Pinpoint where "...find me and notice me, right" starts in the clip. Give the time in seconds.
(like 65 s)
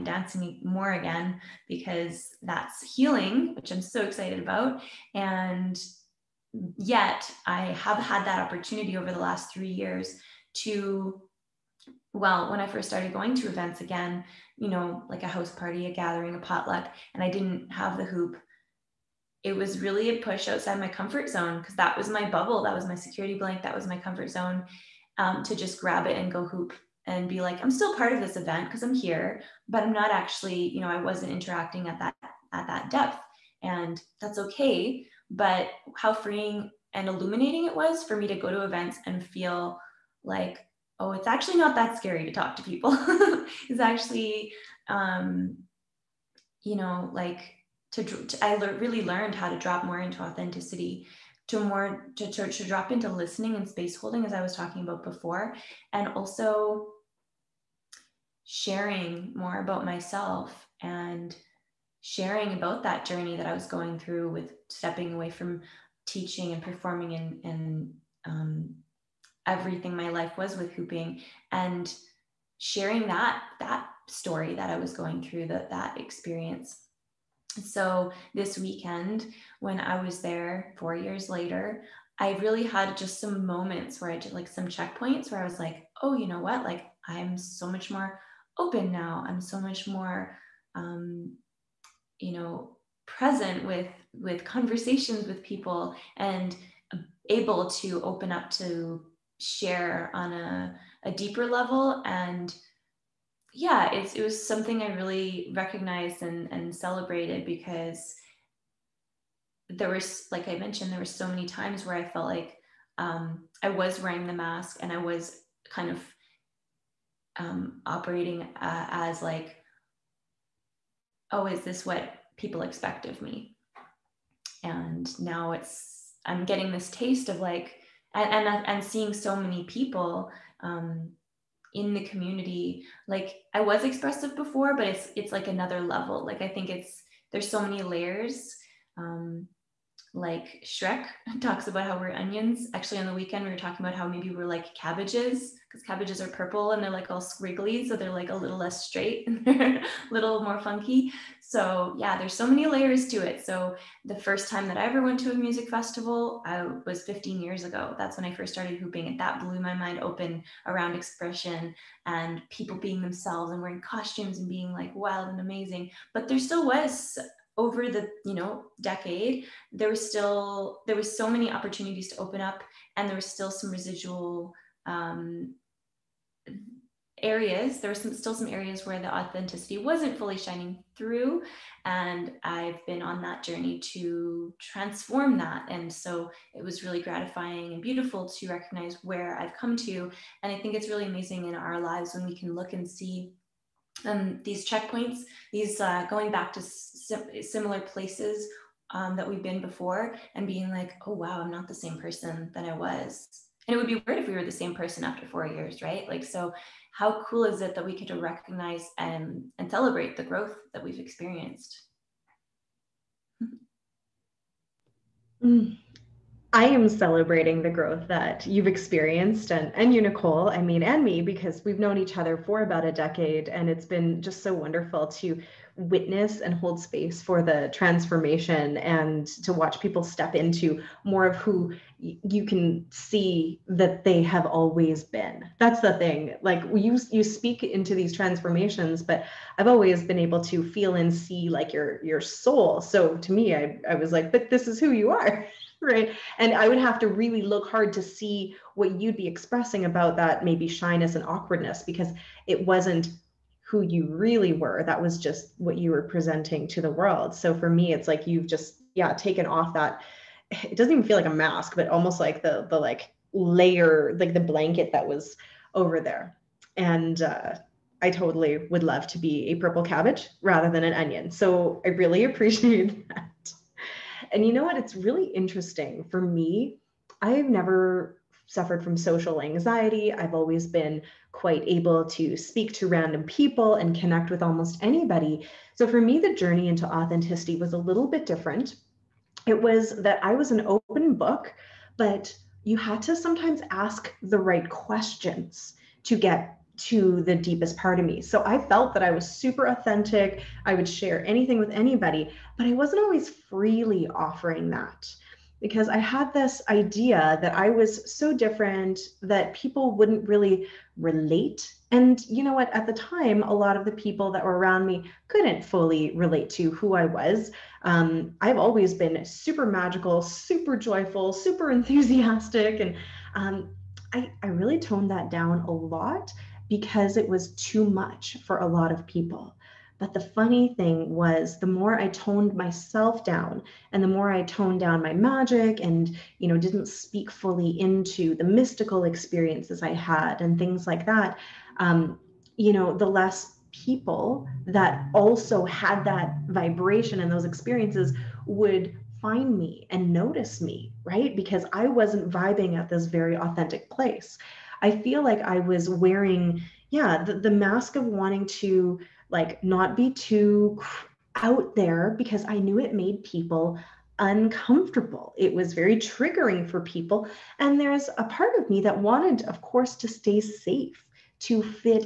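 349 s.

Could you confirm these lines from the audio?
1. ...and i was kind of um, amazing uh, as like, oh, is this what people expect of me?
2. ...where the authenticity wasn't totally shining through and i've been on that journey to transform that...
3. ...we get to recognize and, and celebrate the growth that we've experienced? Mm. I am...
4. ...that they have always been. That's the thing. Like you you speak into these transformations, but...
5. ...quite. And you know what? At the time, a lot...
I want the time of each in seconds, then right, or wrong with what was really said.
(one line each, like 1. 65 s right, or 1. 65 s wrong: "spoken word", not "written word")
1. 114 s wrong: "operating", not "amazing"
2. 178 s wrong: "fully", not "totally"
3. 207 s right
4. 233 s right
5. 310 s wrong: "relate", not "quite".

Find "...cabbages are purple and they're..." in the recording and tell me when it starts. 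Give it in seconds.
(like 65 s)
145 s.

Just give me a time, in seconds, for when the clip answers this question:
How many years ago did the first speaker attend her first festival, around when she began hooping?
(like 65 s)
157 s.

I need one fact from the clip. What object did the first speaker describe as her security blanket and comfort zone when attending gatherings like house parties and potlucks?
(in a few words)
The hoop.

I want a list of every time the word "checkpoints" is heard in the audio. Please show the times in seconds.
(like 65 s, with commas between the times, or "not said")
84 s, 194 s.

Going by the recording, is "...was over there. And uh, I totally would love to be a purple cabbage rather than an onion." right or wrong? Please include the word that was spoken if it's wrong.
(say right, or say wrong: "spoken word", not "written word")
right.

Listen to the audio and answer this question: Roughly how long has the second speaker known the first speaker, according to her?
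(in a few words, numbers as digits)
About a decade.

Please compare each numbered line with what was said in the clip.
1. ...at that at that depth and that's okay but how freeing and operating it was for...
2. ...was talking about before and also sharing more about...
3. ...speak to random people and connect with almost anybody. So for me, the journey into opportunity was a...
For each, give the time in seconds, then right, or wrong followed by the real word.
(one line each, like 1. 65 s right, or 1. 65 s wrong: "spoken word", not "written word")
1. 31 s wrong: "illuminating", not "operating"
2. 54 s right
3. 282 s wrong: "authenticity", not "opportunity".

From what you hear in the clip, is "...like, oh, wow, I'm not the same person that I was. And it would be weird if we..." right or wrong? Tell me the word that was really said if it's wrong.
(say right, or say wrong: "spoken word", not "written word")
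right.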